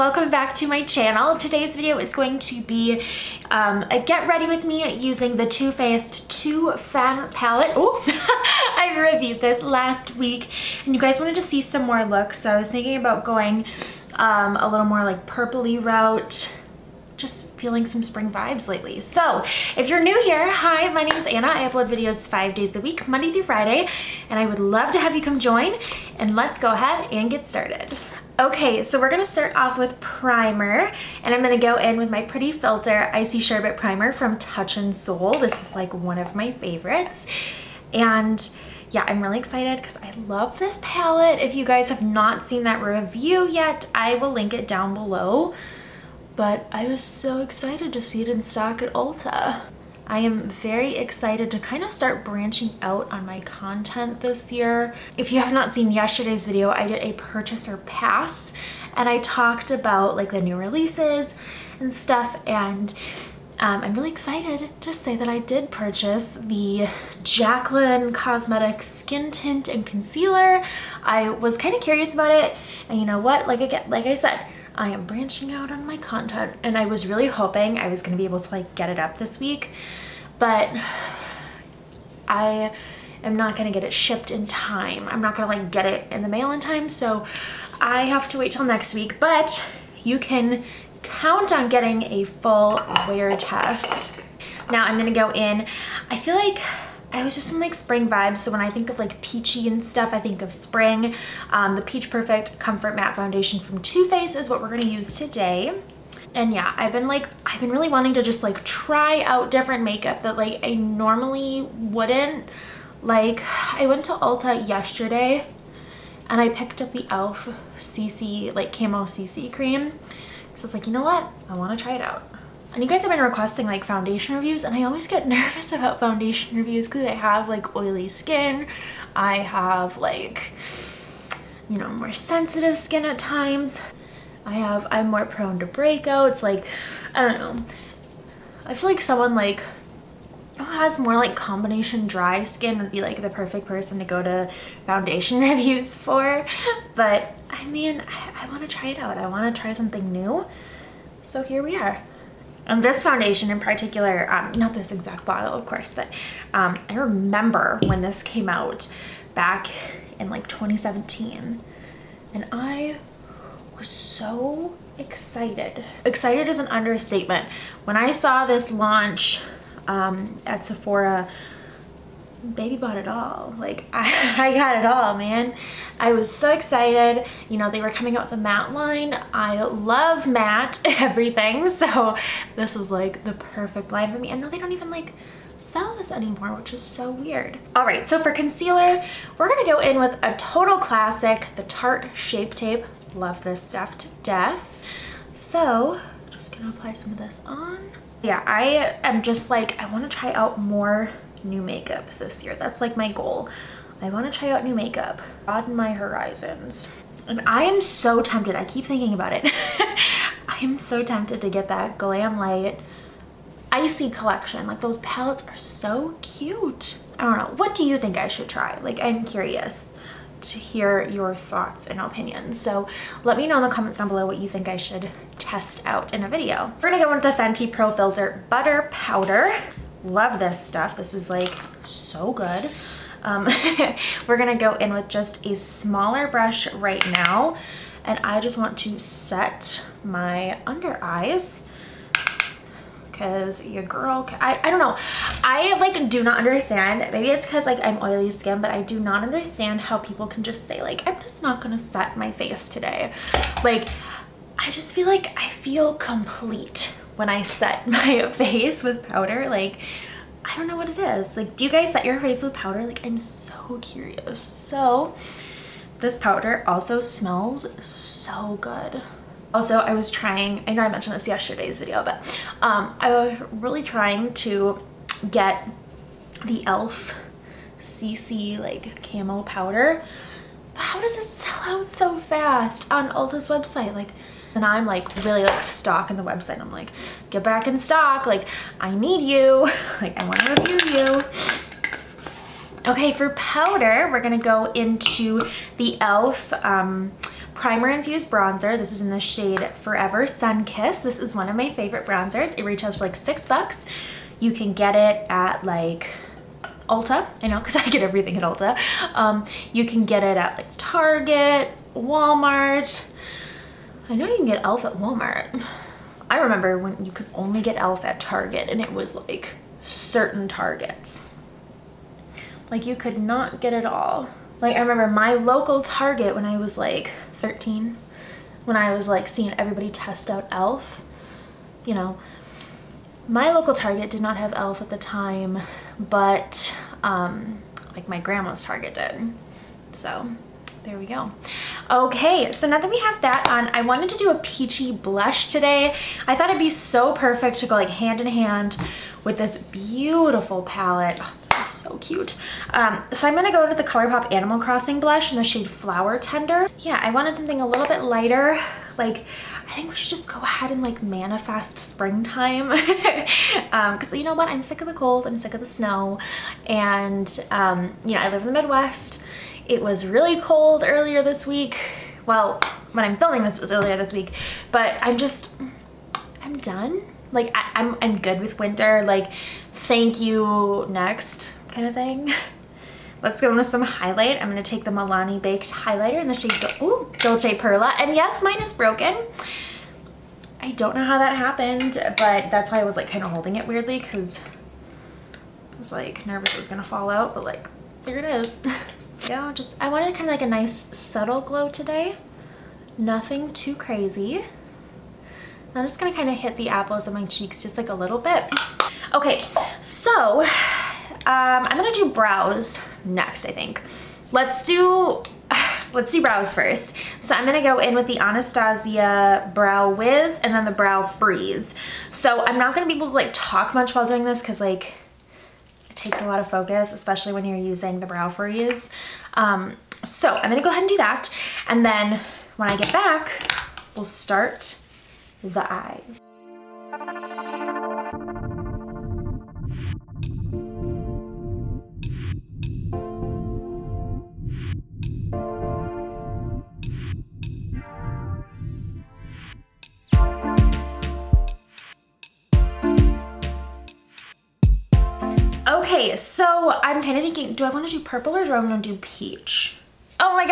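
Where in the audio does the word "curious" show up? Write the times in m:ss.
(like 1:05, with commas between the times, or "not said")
1:11, 3:39, 4:23.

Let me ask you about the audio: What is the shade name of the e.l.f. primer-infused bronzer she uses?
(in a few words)
Forever Sunkissed.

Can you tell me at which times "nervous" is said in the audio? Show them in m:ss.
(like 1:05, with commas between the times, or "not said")
2:05, 6:36.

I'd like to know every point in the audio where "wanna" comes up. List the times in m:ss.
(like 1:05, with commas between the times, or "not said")
2:01, 3:19.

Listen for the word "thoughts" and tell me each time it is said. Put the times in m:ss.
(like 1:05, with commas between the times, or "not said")
3:41, 5:46.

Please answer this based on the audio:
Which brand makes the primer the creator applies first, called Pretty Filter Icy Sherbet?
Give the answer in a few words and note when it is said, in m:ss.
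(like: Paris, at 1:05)
Touch In Sol, at 0:34.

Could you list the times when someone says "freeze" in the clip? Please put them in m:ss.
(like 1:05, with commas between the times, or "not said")
7:01, 7:08.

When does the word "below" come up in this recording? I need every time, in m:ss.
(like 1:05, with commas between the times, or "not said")
0:44, 3:44.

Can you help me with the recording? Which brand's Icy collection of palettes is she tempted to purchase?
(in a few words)
Glamlite.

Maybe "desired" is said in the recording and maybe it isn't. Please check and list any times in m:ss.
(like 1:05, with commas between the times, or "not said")
not said.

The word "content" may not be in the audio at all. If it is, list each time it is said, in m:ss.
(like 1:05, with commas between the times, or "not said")
0:53, 1:15.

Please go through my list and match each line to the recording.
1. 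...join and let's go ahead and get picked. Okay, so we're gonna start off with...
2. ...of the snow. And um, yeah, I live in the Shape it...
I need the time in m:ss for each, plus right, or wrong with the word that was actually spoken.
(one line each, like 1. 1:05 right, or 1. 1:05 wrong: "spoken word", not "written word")
1. 0:25 wrong: "started", not "picked"
2. 6:05 wrong: "Midwest", not "Shape".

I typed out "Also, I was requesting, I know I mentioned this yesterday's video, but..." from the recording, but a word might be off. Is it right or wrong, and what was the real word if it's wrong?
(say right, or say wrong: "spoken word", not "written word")
wrong: "trying", not "requesting".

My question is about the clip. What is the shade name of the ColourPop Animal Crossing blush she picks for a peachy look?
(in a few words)
Flower Tender.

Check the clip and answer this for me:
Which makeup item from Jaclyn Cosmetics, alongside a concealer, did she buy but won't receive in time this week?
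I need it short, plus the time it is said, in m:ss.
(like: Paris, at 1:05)
Skin Tint, at 1:08.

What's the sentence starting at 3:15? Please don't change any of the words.
So just gonna apply some of this on.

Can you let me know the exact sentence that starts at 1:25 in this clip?
I'm not going to like get it in the mail in time.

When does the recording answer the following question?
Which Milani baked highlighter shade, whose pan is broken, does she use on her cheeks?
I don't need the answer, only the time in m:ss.
6:27.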